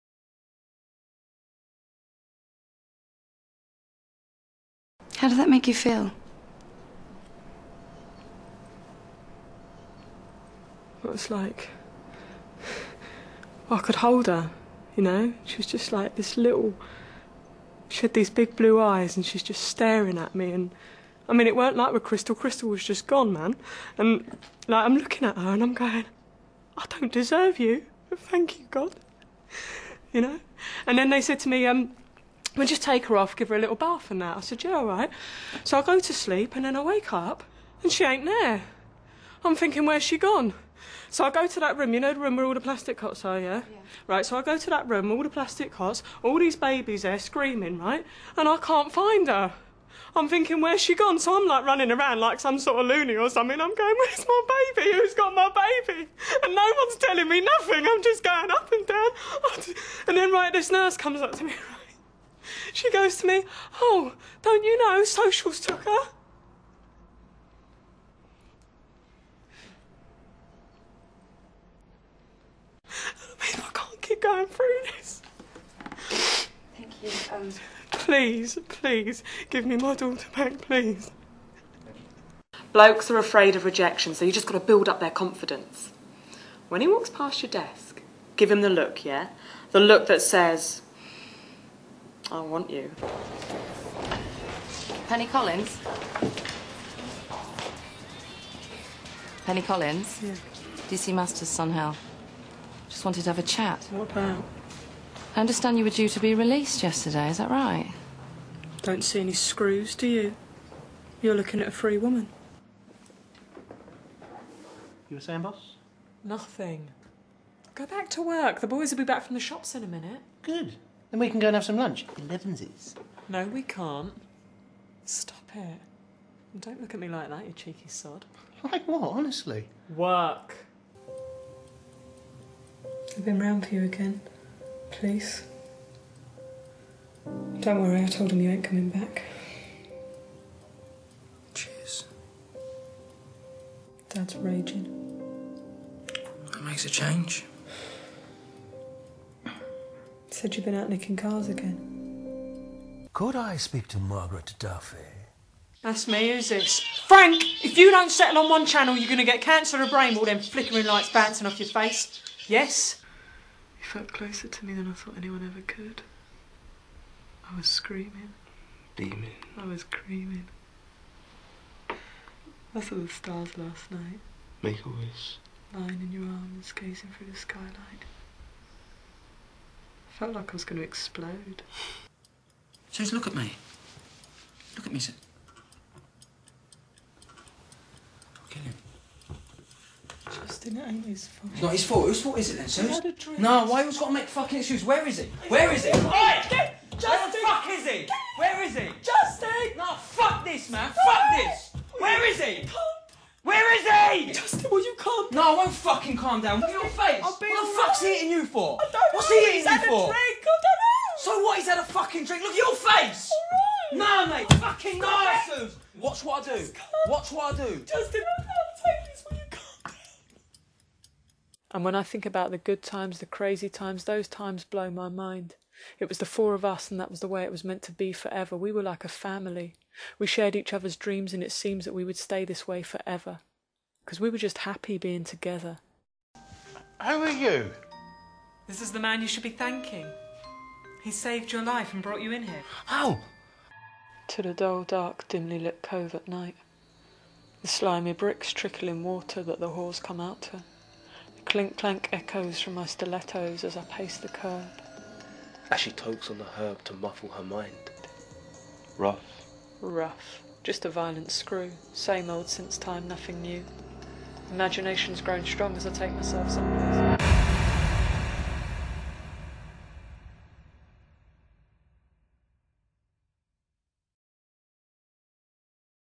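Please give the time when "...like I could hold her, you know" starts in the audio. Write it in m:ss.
0:11.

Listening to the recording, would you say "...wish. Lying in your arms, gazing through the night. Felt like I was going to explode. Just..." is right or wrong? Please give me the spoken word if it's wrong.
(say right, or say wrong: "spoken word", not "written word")
wrong: "skylight", not "night".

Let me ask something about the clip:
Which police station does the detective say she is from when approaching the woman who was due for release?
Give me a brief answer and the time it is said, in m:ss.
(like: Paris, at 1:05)
Sun Hill, at 1:41.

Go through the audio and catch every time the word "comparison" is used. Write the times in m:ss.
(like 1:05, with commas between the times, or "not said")
not said.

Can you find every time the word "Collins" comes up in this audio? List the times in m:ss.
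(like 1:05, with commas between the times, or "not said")
1:35, 1:39.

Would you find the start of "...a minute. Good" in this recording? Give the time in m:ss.
1:59.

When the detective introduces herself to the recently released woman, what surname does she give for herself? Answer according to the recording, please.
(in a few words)
Masters.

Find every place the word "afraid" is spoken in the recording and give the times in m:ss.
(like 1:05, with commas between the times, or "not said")
1:23.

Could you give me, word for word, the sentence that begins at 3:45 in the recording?
It was the four of us, and that was the way it was meant to be forever.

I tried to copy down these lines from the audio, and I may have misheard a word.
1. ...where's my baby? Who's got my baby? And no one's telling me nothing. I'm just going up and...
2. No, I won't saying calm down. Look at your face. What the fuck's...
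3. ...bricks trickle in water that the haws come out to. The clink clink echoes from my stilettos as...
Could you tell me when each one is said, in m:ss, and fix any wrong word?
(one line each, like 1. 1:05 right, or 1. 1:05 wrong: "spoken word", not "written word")
1. 0:53 right
2. 3:25 wrong: "fucking", not "saying"
3. 4:08 wrong: "clank", not "clink".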